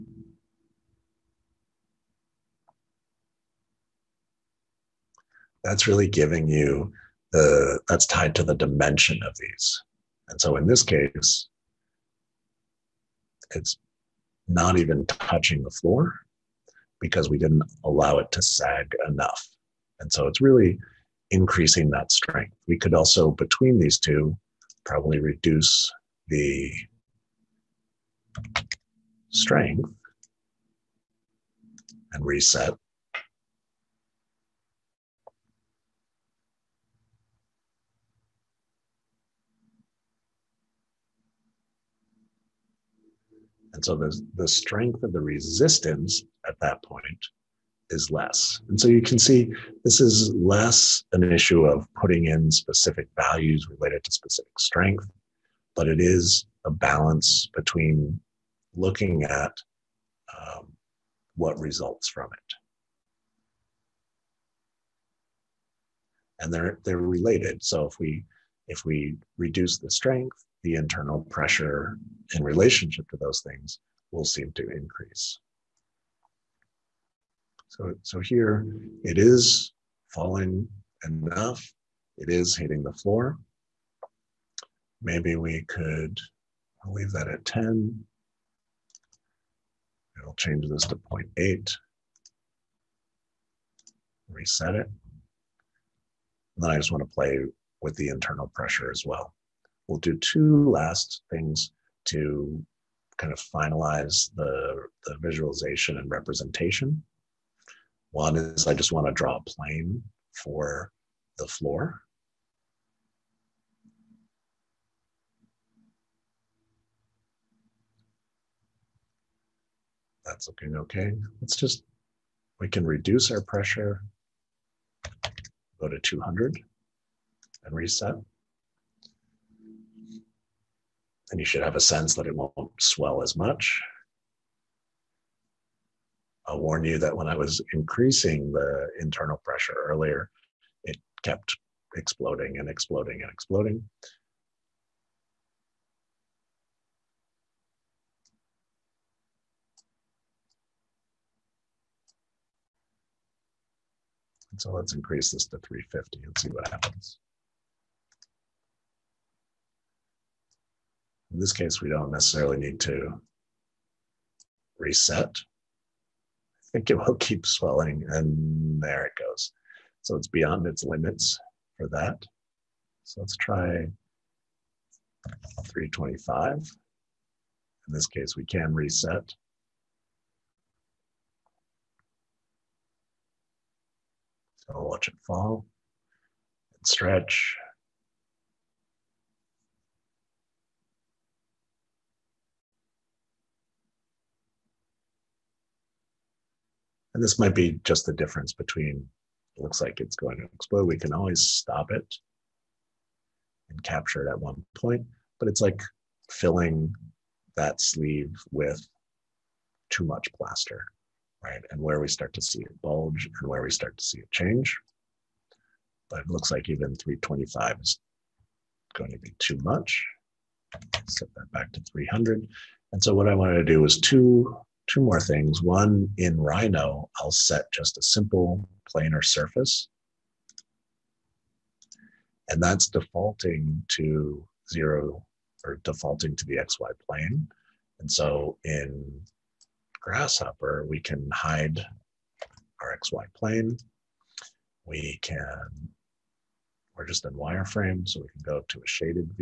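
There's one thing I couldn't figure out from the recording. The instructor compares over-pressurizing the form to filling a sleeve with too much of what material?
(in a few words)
plaster.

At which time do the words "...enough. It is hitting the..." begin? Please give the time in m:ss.
1:21.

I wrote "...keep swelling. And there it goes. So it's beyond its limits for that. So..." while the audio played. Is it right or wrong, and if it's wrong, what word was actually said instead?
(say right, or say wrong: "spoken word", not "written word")
right.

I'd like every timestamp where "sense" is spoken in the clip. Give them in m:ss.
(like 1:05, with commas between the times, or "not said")
2:11.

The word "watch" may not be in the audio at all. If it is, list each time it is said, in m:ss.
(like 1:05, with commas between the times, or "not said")
3:04.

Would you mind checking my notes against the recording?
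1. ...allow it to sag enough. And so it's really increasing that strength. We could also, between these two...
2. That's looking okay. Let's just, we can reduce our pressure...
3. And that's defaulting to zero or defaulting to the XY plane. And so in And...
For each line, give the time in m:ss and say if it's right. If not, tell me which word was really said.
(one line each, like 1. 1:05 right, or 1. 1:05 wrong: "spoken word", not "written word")
1. 0:17 right
2. 2:00 right
3. 3:52 wrong: "Grasshopper", not "And".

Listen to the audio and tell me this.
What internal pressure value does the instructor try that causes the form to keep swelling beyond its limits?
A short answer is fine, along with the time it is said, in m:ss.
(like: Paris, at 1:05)
350, at 2:35.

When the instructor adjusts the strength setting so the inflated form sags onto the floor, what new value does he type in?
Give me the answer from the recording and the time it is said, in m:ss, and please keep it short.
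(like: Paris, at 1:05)
0.8, at 1:30.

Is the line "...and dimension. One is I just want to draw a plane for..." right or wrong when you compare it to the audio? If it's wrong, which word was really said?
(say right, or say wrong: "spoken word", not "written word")
wrong: "representation", not "dimension".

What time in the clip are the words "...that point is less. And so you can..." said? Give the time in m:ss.
0:46.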